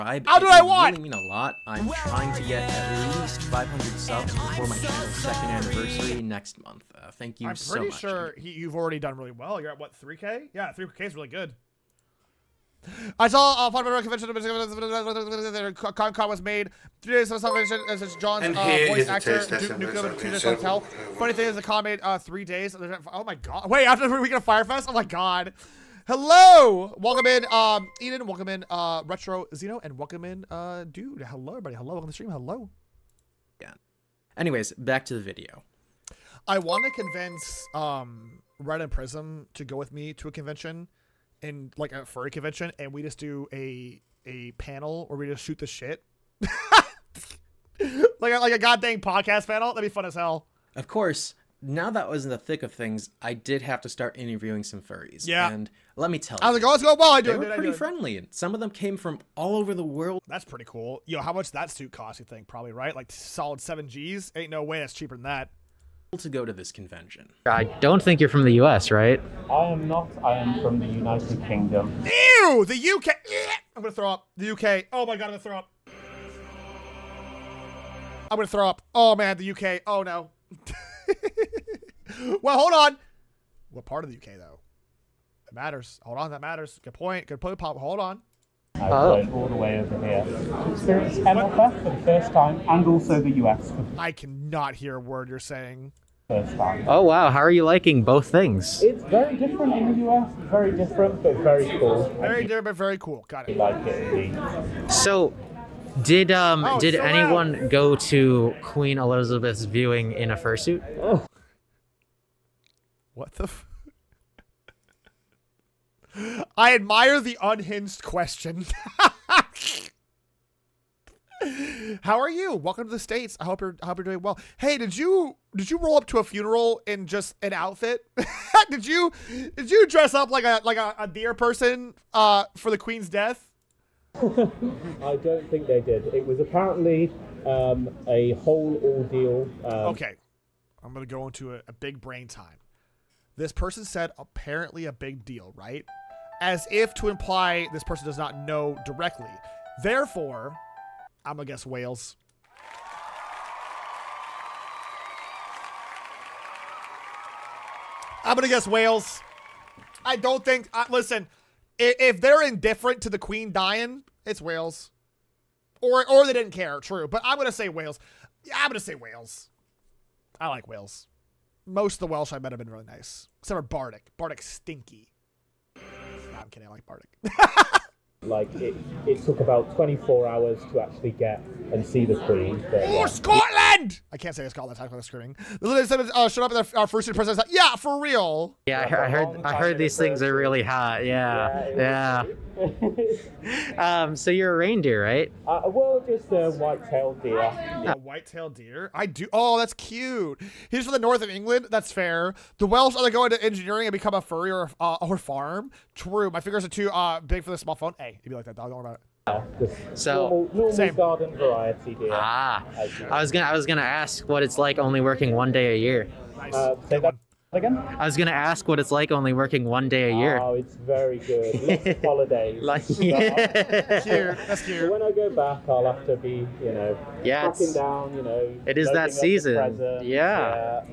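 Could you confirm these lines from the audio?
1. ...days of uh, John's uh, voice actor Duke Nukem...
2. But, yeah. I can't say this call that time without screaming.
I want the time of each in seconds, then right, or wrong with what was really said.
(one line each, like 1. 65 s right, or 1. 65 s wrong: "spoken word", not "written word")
1. 17 s right
2. 182 s right.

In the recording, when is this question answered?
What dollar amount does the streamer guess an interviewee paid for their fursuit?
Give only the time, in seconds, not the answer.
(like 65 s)
63 s.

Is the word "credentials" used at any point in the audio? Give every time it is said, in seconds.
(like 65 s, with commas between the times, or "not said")
not said.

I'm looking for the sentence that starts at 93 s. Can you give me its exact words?
I cannot hear a word you're saying.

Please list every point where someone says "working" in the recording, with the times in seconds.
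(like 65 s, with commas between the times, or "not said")
214 s, 219 s.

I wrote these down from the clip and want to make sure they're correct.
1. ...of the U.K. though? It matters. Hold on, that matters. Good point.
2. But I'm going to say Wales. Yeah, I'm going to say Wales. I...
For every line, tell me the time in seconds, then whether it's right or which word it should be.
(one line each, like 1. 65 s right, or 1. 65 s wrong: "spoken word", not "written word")
1. 84 s right
2. 167 s right.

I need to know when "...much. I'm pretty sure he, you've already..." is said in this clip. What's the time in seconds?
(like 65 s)
7 s.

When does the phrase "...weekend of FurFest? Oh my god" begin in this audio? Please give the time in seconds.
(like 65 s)
24 s.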